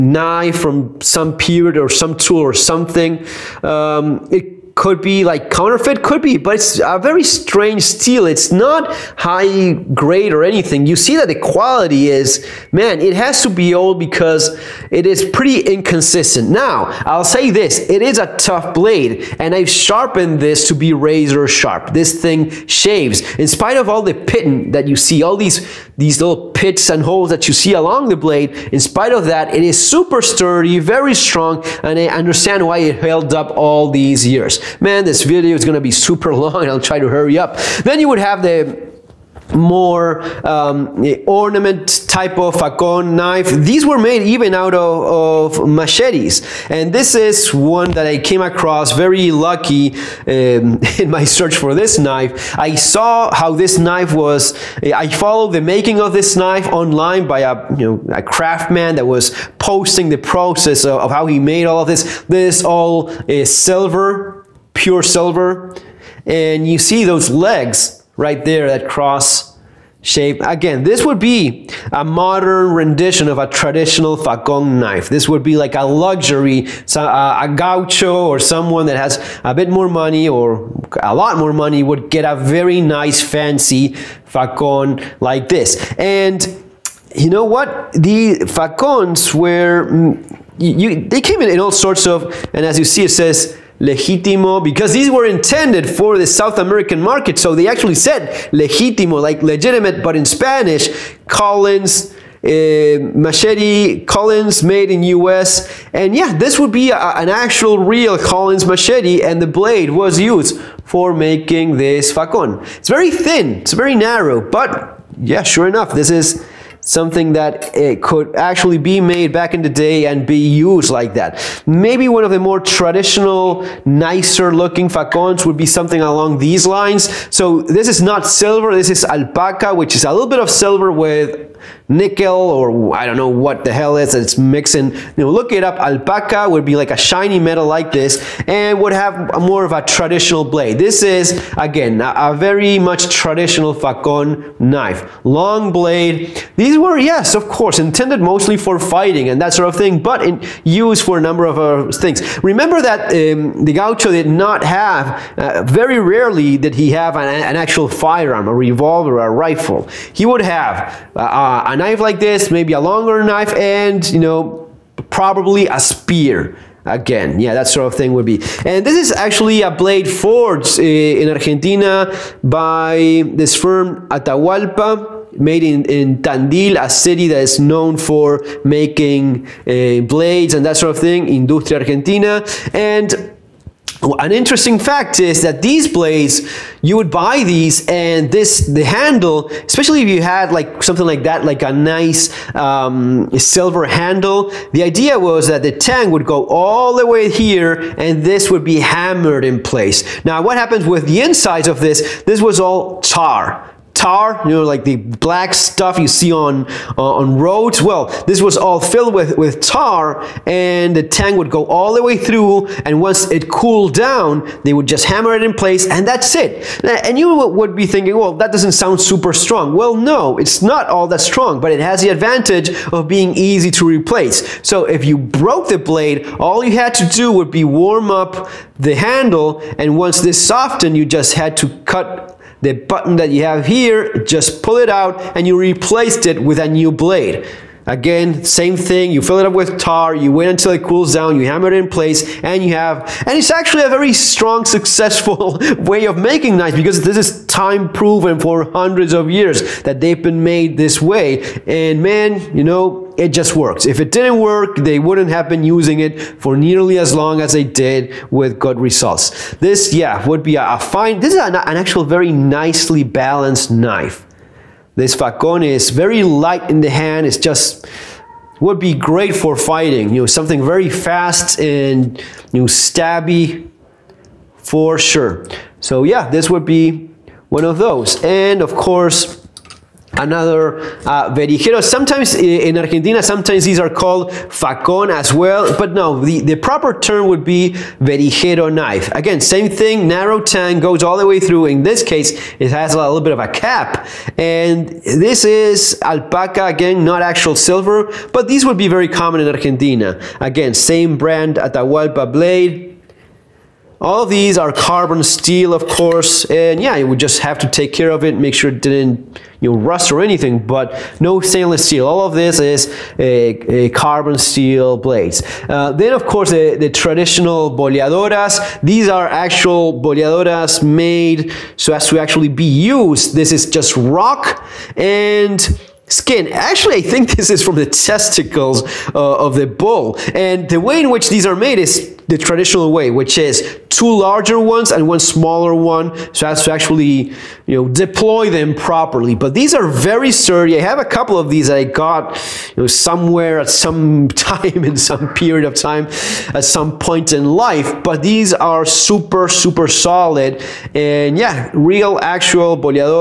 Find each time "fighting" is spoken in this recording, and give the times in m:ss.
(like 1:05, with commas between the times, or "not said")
2:28, 4:29.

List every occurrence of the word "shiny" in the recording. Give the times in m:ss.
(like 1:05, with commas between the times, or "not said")
2:16.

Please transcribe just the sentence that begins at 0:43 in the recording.
These were made even out of, of, machetes.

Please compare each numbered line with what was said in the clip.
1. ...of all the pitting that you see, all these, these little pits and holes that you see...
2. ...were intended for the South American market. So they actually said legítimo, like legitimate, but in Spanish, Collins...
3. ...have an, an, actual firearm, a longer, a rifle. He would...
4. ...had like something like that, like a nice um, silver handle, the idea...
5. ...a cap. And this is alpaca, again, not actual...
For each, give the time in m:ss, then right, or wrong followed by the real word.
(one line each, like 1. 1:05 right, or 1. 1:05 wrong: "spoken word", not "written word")
1. 0:23 right
2. 1:35 right
3. 2:36 wrong: "revolver", not "longer"
4. 3:10 right
5. 4:53 right.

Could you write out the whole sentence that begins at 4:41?
Sometimes in Argentina, sometimes these are called facon as well, but no, the, the proper term would be verijero knife.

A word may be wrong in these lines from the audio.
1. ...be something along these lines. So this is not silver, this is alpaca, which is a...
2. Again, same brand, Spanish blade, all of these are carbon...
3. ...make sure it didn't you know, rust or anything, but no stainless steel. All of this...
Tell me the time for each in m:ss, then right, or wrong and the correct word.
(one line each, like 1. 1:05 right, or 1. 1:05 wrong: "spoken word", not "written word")
1. 2:05 right
2. 5:00 wrong: "Atahualpa", not "Spanish"
3. 5:08 right.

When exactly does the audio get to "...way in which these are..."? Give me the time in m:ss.
5:30.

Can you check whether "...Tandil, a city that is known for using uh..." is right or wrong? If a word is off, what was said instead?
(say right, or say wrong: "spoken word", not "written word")
wrong: "making", not "using".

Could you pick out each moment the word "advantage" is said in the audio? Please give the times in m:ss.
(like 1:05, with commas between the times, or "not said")
3:42.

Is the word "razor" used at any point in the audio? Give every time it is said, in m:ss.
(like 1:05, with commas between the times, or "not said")
0:20.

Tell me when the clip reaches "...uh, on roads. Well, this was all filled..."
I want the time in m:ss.
3:26.